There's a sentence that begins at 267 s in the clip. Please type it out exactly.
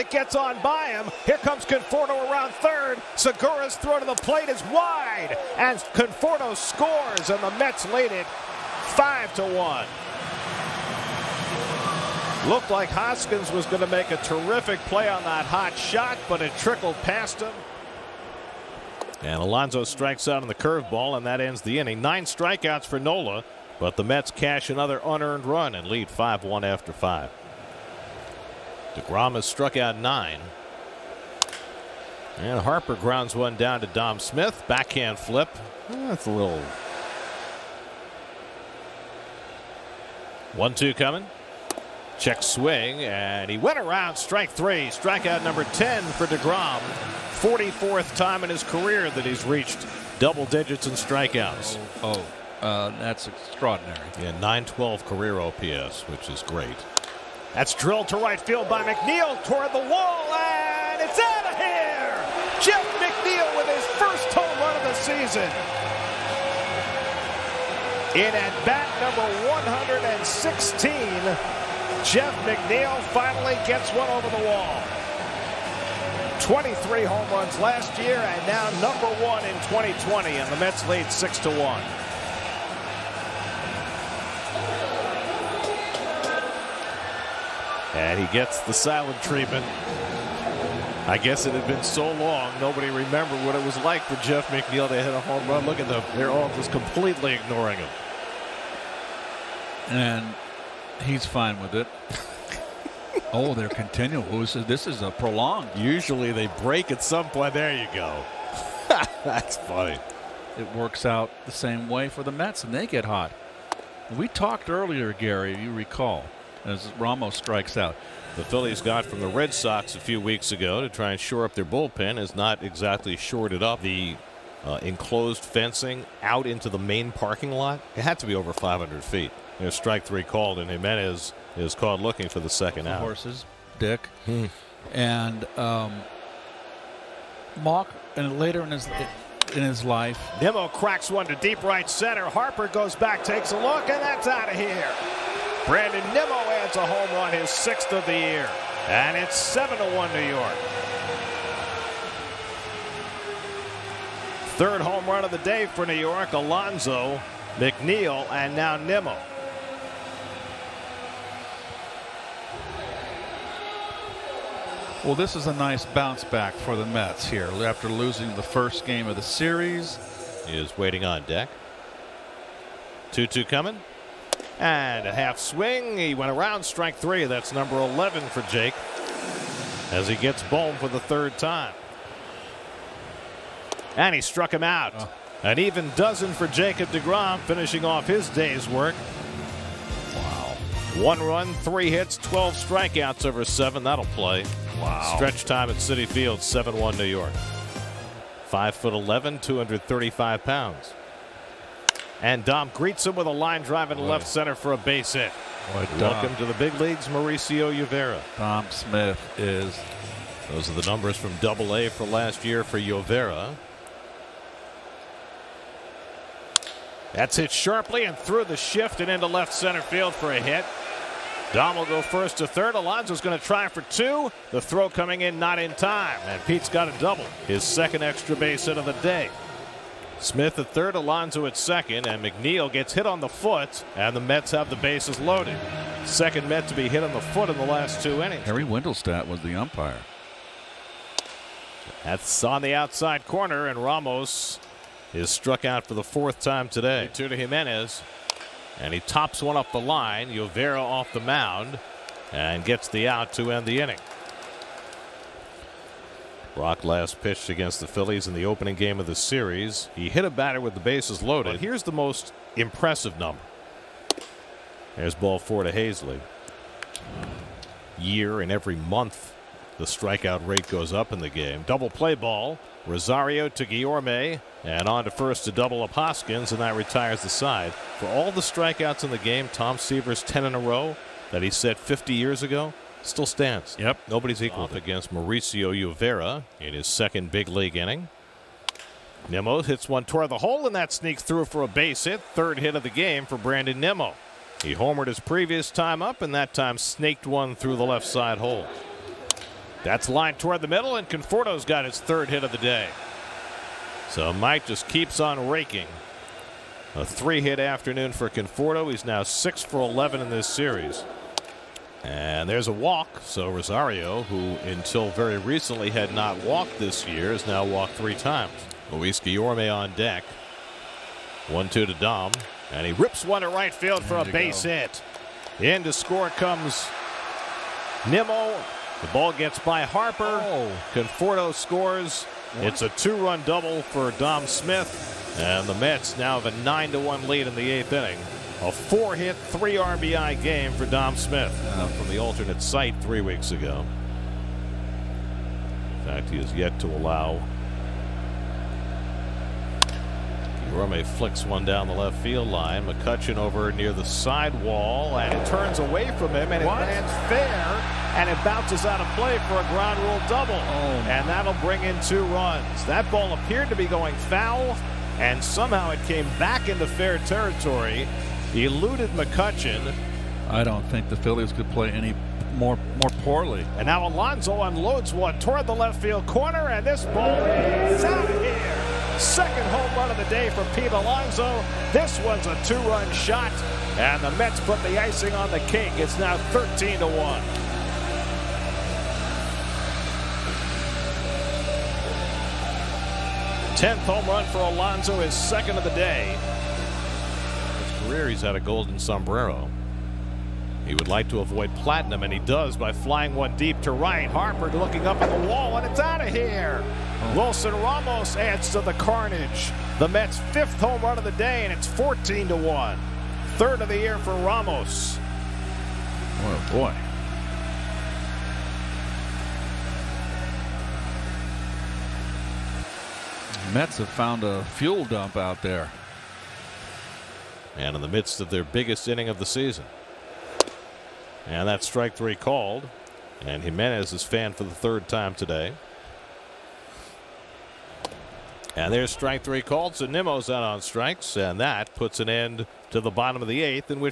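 Year and every month the strikeout rate goes up in the game.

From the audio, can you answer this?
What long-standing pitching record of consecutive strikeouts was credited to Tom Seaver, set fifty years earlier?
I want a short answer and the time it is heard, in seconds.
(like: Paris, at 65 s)
10 in a row, at 280 s.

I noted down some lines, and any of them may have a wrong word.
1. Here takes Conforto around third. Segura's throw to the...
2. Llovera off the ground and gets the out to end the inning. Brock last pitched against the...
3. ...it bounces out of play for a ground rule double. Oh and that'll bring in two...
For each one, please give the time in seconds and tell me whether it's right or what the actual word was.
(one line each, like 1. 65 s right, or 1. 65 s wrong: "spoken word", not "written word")
1. 1 s wrong: "comes", not "takes"
2. 250 s wrong: "mound", not "ground"
3. 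358 s right.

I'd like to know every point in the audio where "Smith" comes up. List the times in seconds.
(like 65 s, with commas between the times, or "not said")
34 s, 208 s, 230 s, 334 s, 341 s.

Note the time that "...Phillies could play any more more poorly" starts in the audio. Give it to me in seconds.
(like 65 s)
371 s.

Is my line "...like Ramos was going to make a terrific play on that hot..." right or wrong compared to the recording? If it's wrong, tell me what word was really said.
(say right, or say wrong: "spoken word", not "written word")
wrong: "Hoskins", not "Ramos".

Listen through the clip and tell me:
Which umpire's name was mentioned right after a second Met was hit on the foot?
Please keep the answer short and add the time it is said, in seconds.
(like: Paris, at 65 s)
Harry Wendelstedt, at 238 s.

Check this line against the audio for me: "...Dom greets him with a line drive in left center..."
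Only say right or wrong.
right.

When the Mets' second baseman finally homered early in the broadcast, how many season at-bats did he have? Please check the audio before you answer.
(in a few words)
116.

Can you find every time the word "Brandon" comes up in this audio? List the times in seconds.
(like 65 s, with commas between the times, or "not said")
145 s, 293 s.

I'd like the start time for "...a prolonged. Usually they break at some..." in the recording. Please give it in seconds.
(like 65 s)
105 s.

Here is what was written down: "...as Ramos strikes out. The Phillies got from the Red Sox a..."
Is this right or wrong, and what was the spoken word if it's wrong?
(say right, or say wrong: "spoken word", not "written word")
right.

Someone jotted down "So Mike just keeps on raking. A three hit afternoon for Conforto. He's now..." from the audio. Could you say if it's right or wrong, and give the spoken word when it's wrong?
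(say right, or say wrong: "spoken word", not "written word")
right.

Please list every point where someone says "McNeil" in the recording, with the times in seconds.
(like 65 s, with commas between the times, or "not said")
58 s, 62 s, 72 s, 94 s, 157 s, 232 s.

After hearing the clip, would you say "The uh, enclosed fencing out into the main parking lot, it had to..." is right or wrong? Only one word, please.
right.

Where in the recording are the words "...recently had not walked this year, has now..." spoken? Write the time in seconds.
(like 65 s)
315 s.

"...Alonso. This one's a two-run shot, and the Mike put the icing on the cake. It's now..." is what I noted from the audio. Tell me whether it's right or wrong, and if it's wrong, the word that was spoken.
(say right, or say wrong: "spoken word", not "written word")
wrong: "Mets", not "Mike".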